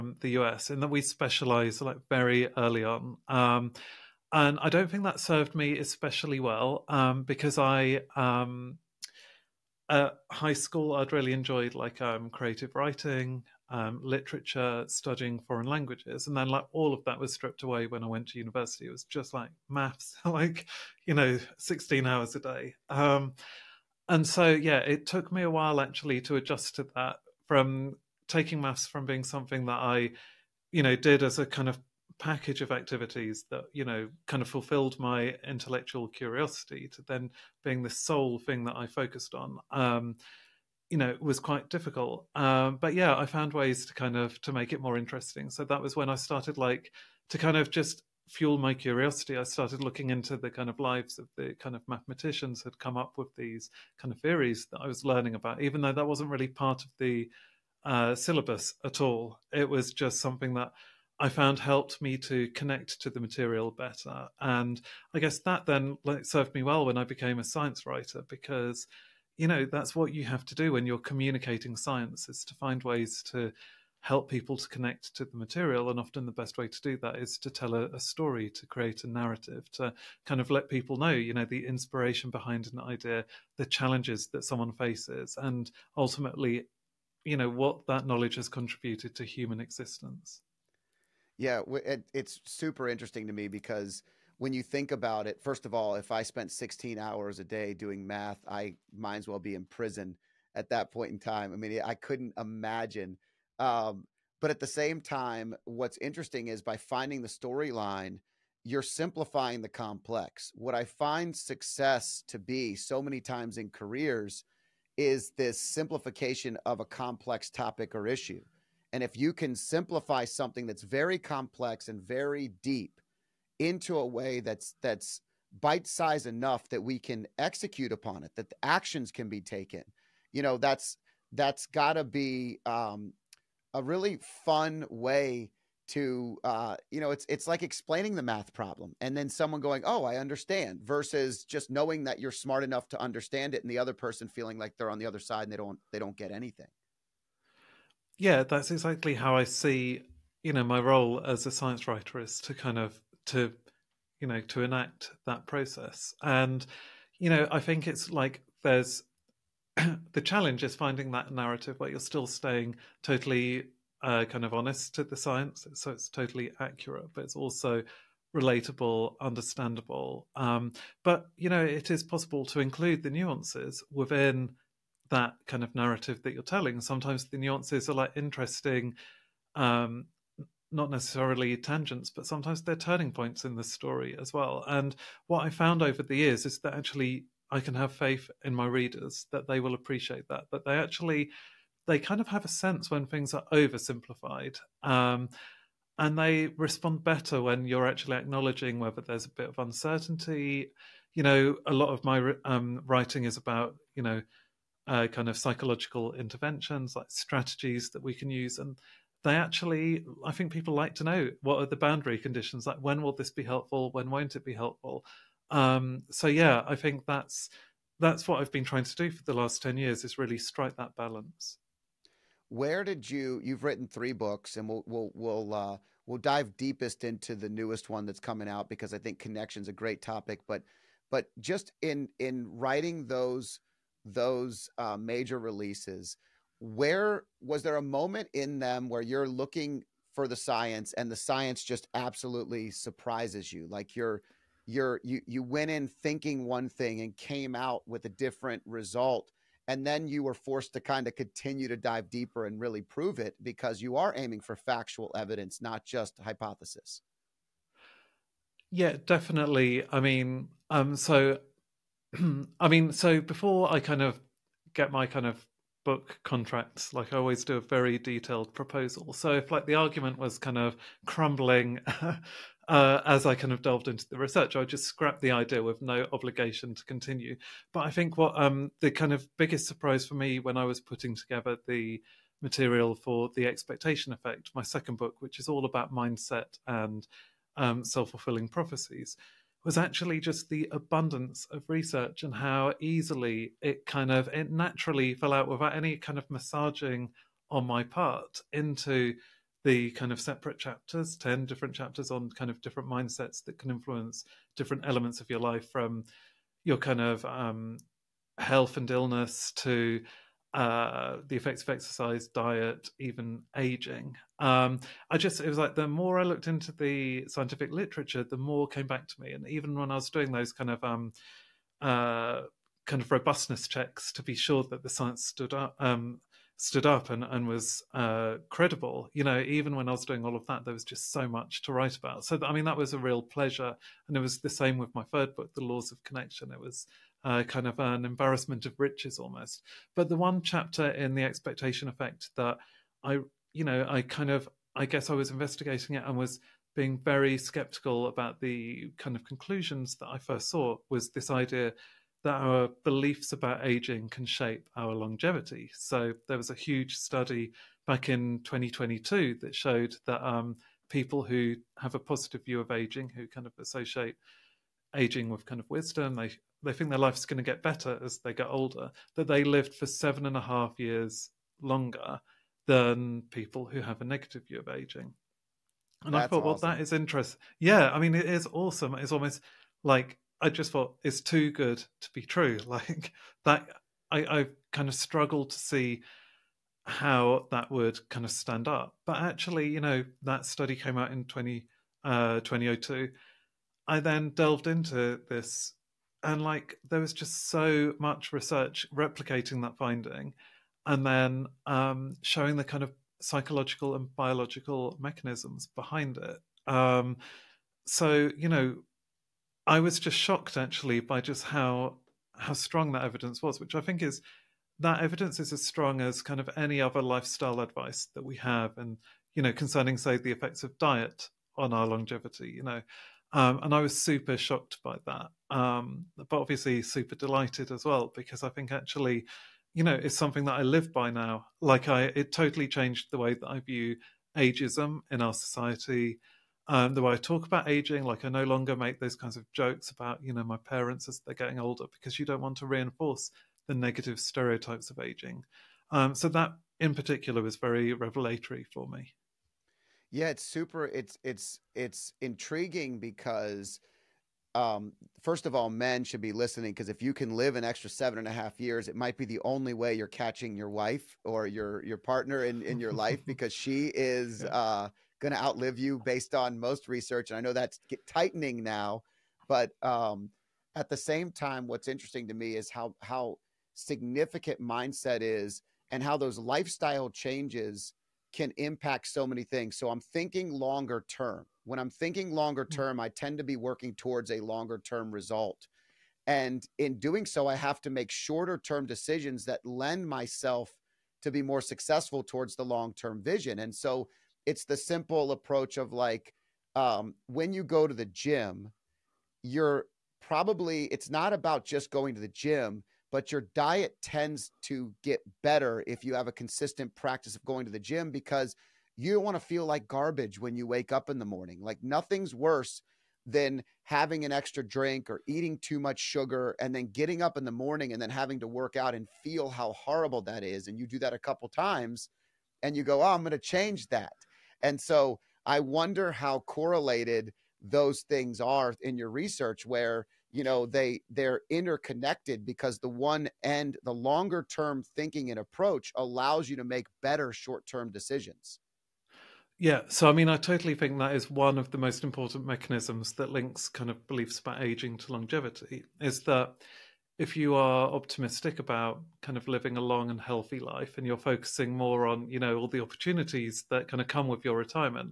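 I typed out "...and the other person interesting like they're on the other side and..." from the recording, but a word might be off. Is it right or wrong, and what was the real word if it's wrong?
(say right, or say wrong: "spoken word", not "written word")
wrong: "feeling", not "interesting".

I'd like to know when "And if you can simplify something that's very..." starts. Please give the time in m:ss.
1:58.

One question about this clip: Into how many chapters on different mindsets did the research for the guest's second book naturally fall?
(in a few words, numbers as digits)
10.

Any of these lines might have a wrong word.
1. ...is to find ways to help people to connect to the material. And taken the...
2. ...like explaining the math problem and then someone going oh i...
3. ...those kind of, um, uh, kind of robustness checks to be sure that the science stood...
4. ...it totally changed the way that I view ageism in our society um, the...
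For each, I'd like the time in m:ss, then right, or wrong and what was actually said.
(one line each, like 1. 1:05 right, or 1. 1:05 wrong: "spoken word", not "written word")
1. 1:12 wrong: "often", not "taken"
2. 2:17 right
3. 5:20 right
4. 7:12 right.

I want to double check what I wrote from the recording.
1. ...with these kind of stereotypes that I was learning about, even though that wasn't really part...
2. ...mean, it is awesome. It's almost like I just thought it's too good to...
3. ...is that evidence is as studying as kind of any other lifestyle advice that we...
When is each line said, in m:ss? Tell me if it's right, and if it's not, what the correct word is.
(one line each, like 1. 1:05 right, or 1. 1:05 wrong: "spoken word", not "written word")
1. 0:53 wrong: "theories", not "stereotypes"
2. 6:17 right
3. 6:54 wrong: "strong", not "studying".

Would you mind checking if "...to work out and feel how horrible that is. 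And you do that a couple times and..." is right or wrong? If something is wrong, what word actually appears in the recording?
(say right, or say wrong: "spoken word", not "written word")
right.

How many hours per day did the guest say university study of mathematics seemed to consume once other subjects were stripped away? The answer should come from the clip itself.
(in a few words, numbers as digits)
16.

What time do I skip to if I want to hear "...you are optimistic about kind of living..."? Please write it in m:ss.
9:07.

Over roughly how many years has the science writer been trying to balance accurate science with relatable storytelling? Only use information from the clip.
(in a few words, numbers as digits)
10.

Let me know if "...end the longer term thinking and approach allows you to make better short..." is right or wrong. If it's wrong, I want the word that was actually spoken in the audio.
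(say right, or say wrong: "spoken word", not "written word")
right.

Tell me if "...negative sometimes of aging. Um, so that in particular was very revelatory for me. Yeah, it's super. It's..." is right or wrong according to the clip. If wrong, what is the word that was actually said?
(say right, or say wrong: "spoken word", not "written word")
wrong: "stereotypes", not "sometimes".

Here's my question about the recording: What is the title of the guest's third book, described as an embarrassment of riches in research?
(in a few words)
The Laws of Connection.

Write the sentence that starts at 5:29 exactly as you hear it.
You know, even when I was doing all of that, there was just so much to write about.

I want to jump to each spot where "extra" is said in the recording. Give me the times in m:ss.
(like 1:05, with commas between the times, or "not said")
7:37, 8:34.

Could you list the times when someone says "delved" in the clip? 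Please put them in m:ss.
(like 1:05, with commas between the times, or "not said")
4:33, 6:34.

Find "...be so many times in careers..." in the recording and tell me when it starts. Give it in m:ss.
1:52.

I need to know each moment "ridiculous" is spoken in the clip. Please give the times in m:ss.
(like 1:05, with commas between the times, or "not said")
not said.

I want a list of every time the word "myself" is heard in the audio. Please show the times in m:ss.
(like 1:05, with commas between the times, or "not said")
8:10.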